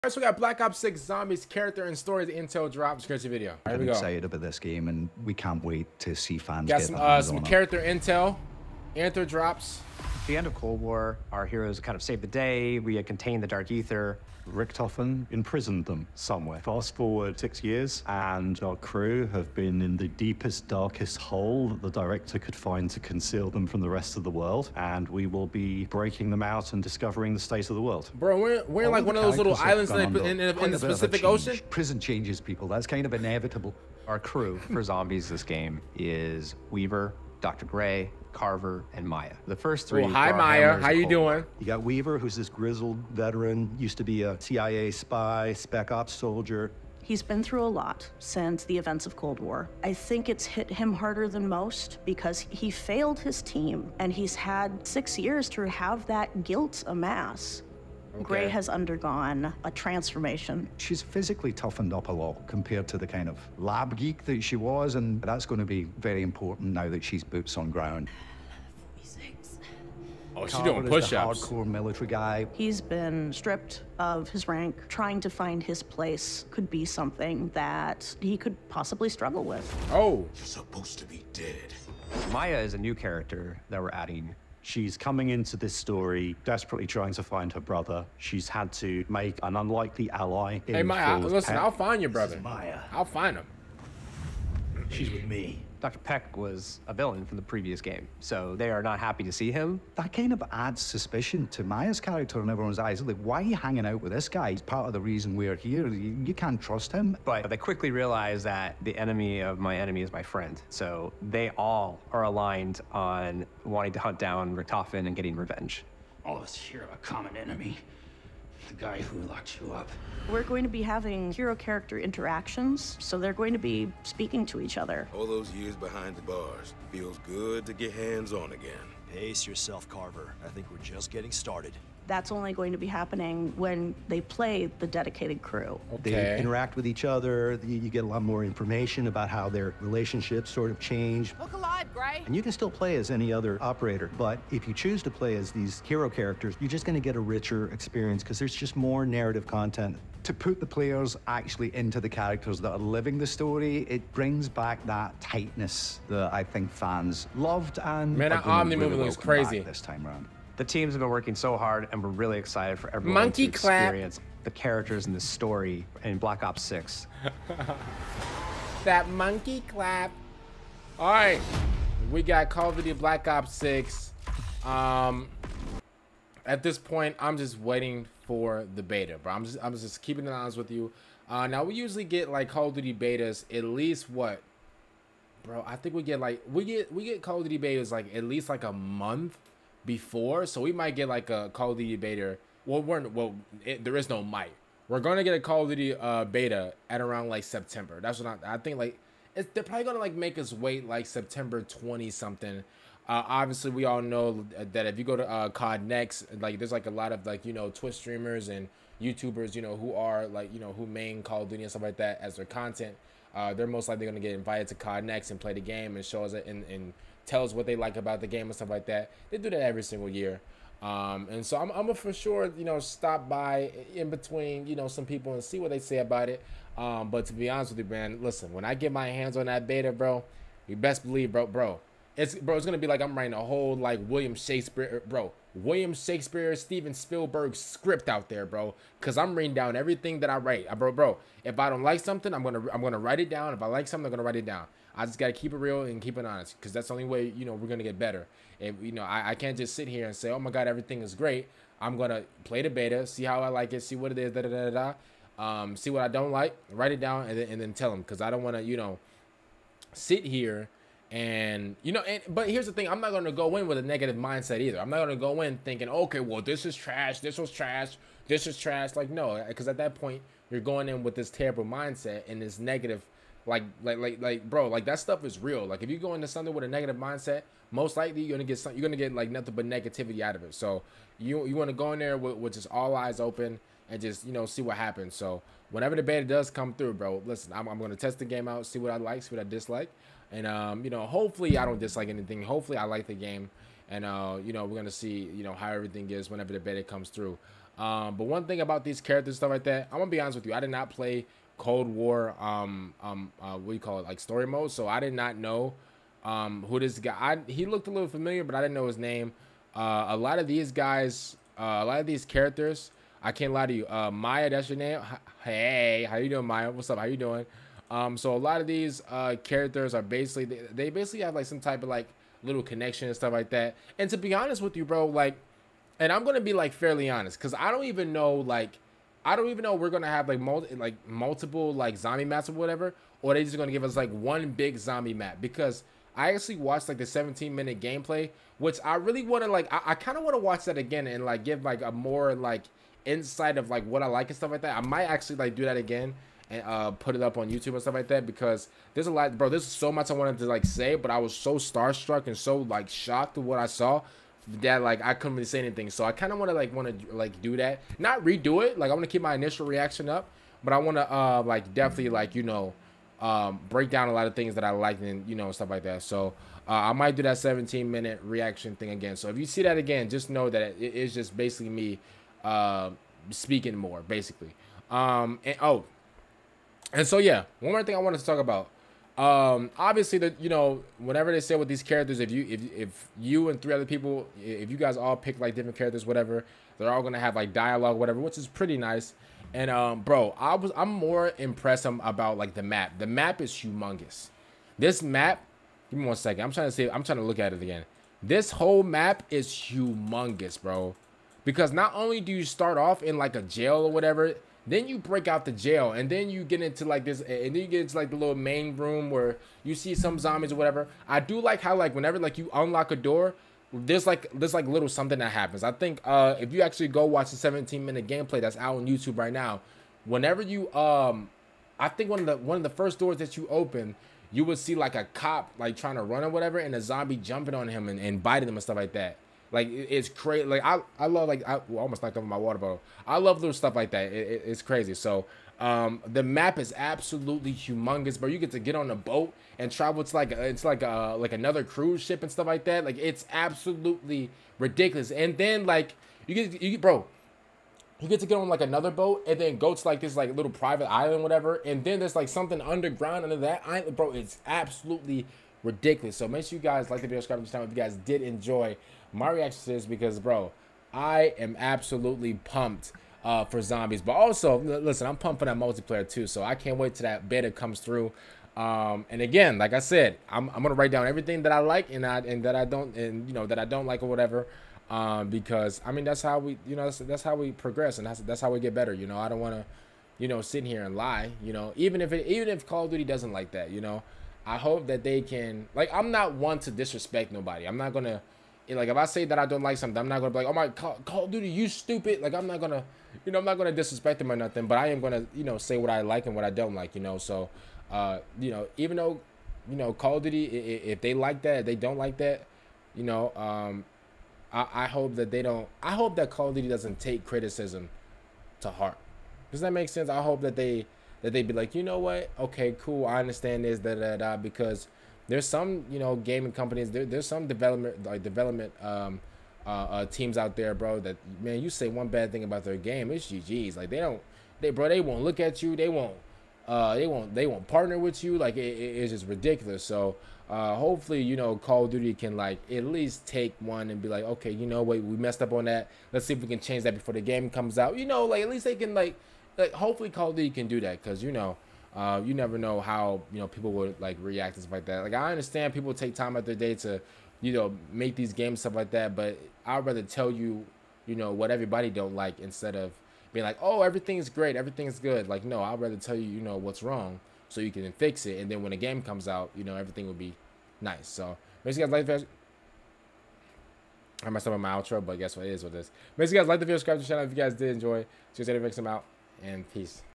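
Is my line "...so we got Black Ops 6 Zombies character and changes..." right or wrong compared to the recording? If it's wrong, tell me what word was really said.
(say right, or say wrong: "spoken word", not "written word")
wrong: "stories", not "changes".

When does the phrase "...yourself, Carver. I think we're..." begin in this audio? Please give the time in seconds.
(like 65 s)
129 s.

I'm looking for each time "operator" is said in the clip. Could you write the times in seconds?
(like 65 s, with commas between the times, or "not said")
143 s.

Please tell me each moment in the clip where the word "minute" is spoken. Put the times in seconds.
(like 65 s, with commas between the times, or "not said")
337 s, 367 s, 417 s.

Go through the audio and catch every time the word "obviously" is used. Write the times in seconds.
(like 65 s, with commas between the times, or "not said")
203 s, 379 s.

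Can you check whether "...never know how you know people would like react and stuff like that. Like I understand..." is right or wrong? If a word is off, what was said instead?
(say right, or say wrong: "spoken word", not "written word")
right.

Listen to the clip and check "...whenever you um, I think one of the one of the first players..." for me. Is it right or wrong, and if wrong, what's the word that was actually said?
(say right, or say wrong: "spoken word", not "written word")
wrong: "doors", not "players".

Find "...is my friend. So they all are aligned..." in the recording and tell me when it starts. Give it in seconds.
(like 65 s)
110 s.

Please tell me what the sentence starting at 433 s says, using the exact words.
I love little stuff like that.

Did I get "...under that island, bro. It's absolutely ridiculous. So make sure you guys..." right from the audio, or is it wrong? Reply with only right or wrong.
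right.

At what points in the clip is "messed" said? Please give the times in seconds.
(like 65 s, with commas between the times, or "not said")
535 s, 564 s.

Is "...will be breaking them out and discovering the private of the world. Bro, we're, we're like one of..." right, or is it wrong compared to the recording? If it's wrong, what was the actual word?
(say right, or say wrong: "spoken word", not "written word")
wrong: "state", not "private".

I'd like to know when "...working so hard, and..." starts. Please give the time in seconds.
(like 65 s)
161 s.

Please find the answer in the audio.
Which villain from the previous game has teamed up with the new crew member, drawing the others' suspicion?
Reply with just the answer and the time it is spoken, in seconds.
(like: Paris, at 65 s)
Dr. Peck, at 95 s.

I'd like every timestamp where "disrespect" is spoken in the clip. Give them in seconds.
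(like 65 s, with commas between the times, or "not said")
486 s, 493 s.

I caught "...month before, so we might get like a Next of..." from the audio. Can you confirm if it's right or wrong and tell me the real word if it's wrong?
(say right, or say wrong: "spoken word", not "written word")
wrong: "Call", not "Next".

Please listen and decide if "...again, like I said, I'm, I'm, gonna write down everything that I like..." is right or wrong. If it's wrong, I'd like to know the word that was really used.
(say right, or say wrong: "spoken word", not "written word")
right.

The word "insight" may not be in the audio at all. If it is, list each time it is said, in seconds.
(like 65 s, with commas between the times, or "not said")
343 s.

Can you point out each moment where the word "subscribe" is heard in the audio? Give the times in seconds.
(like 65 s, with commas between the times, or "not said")
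457 s, 566 s.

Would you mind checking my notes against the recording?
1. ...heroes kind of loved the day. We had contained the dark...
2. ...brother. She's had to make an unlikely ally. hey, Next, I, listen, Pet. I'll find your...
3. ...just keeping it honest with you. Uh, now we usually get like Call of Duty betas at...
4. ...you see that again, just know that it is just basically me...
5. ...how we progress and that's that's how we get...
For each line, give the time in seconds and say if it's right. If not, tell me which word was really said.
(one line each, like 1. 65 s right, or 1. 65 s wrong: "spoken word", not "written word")
1. 11 s wrong: "saved", not "loved"
2. 87 s wrong: "Maya", not "Next"
3. 179 s right
4. 369 s right
5. 477 s right.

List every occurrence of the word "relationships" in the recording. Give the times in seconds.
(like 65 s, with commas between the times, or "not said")
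139 s.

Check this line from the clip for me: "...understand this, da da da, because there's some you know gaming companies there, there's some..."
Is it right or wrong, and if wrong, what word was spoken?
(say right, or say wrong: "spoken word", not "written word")
right.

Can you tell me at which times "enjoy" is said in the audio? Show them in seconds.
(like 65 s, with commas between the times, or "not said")
458 s, 567 s.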